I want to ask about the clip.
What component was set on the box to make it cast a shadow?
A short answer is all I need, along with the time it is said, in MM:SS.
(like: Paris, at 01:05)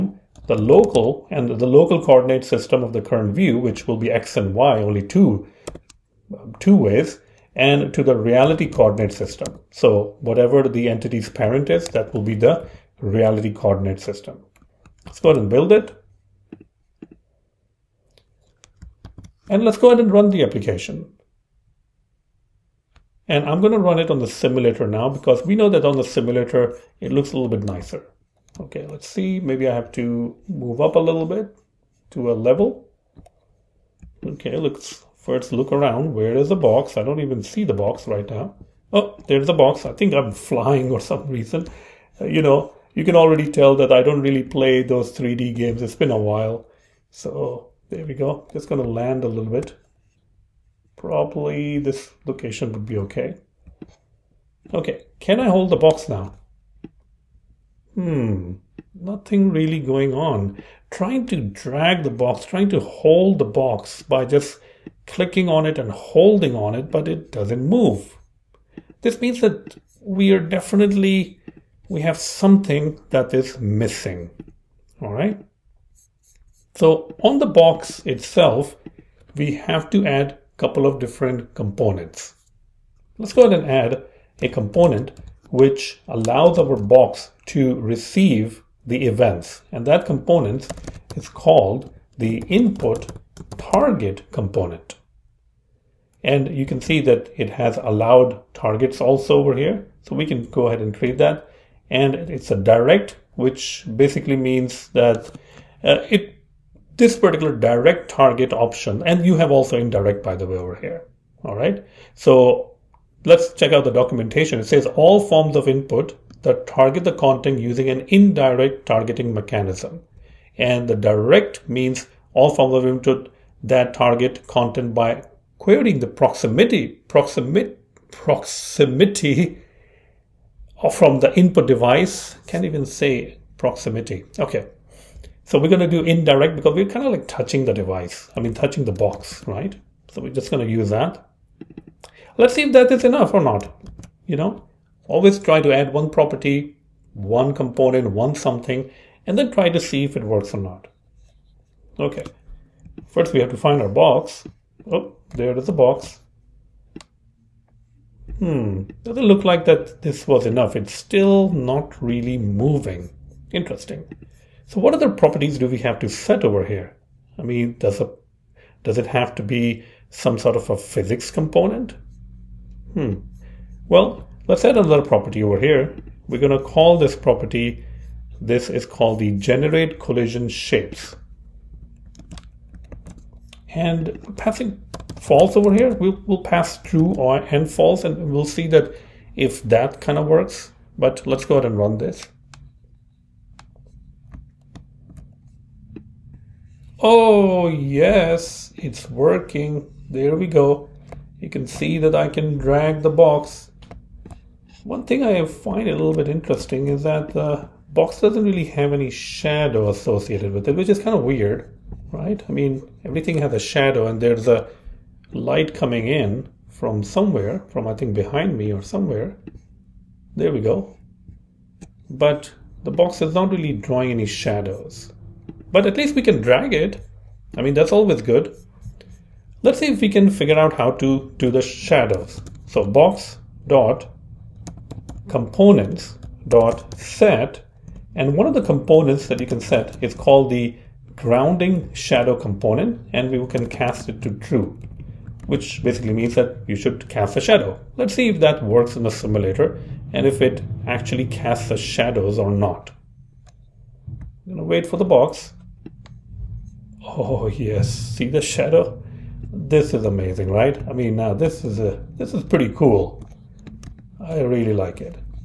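grounding shadow component, at 04:01.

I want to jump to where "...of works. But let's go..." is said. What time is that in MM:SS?
03:10.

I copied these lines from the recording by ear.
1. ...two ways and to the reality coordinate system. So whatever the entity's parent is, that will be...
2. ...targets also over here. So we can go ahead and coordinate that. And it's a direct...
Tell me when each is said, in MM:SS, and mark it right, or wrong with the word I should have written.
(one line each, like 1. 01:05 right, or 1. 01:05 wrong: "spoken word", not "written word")
1. 00:06 right
2. 01:38 wrong: "create", not "coordinate".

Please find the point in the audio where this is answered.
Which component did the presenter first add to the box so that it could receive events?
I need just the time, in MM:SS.
01:32.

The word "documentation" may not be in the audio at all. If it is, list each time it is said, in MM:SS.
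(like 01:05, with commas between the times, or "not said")
01:53.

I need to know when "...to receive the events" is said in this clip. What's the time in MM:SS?
01:27.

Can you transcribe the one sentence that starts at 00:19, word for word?
And let's go ahead and run the application.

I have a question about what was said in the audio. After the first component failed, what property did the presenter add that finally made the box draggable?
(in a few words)
generate collision shapes.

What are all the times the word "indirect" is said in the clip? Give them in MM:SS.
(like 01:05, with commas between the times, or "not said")
01:49, 01:58, 02:16.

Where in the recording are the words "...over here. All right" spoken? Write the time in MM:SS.
01:50.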